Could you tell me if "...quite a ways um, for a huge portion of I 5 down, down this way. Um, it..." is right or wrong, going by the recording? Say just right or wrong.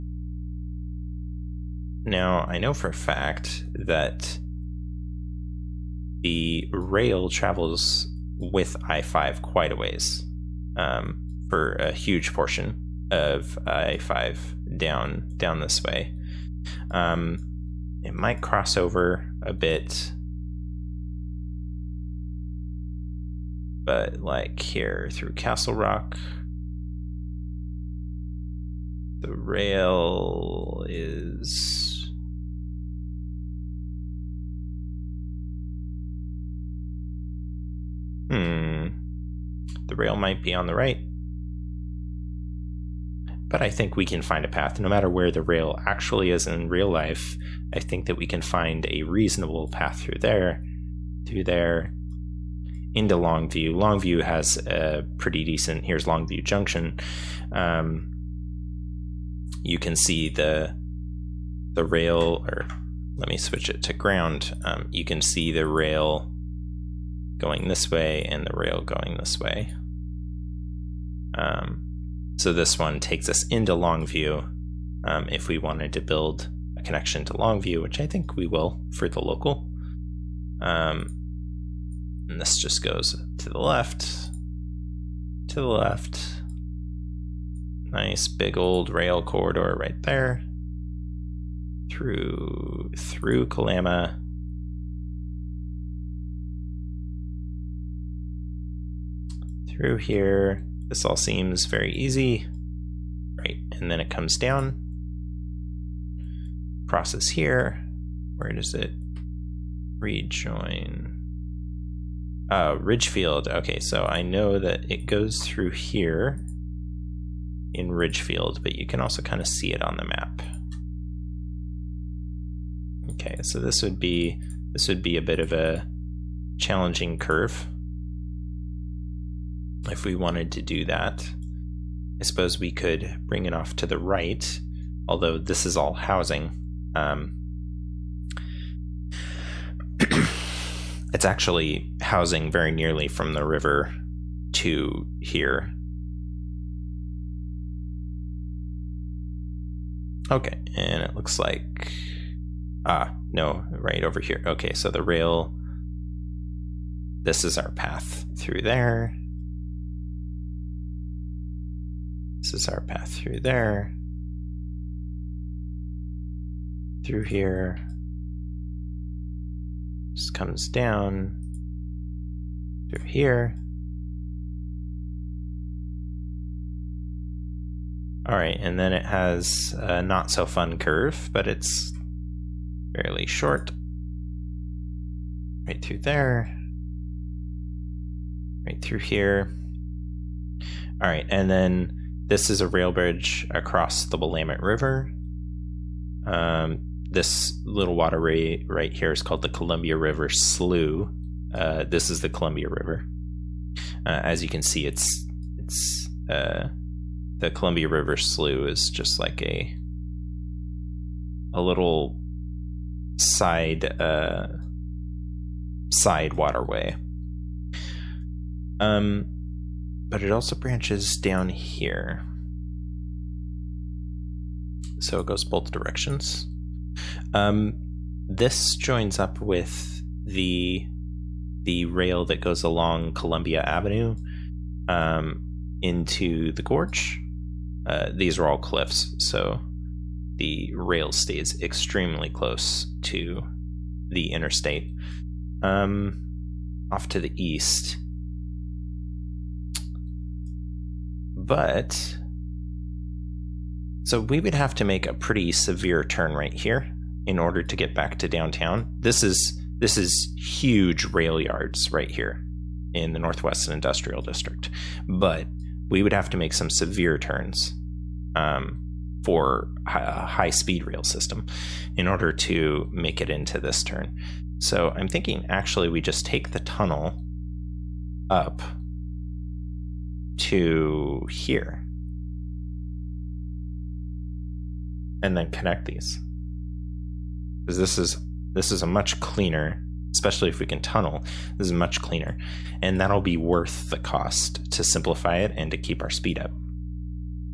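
right.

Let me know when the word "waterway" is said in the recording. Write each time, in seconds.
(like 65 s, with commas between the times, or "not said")
197 s, 216 s.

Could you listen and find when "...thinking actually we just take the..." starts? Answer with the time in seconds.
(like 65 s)
275 s.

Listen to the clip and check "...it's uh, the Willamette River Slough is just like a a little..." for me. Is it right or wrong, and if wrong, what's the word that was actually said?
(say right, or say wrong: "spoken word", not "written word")
wrong: "Columbia", not "Willamette".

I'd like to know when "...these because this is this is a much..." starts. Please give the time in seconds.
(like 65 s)
285 s.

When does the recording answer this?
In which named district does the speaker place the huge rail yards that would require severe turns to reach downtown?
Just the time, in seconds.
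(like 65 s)
263 s.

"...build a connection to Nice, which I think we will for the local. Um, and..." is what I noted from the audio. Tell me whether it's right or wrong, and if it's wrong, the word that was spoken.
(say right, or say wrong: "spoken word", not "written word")
wrong: "Longview", not "Nice".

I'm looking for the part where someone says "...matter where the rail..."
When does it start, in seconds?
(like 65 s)
44 s.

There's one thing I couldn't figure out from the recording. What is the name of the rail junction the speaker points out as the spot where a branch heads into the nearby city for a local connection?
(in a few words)
Longview Junction.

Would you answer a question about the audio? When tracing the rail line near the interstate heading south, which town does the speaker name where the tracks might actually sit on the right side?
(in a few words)
Castle Rock.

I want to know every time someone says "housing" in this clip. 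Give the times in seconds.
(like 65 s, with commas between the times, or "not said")
135 s, 142 s.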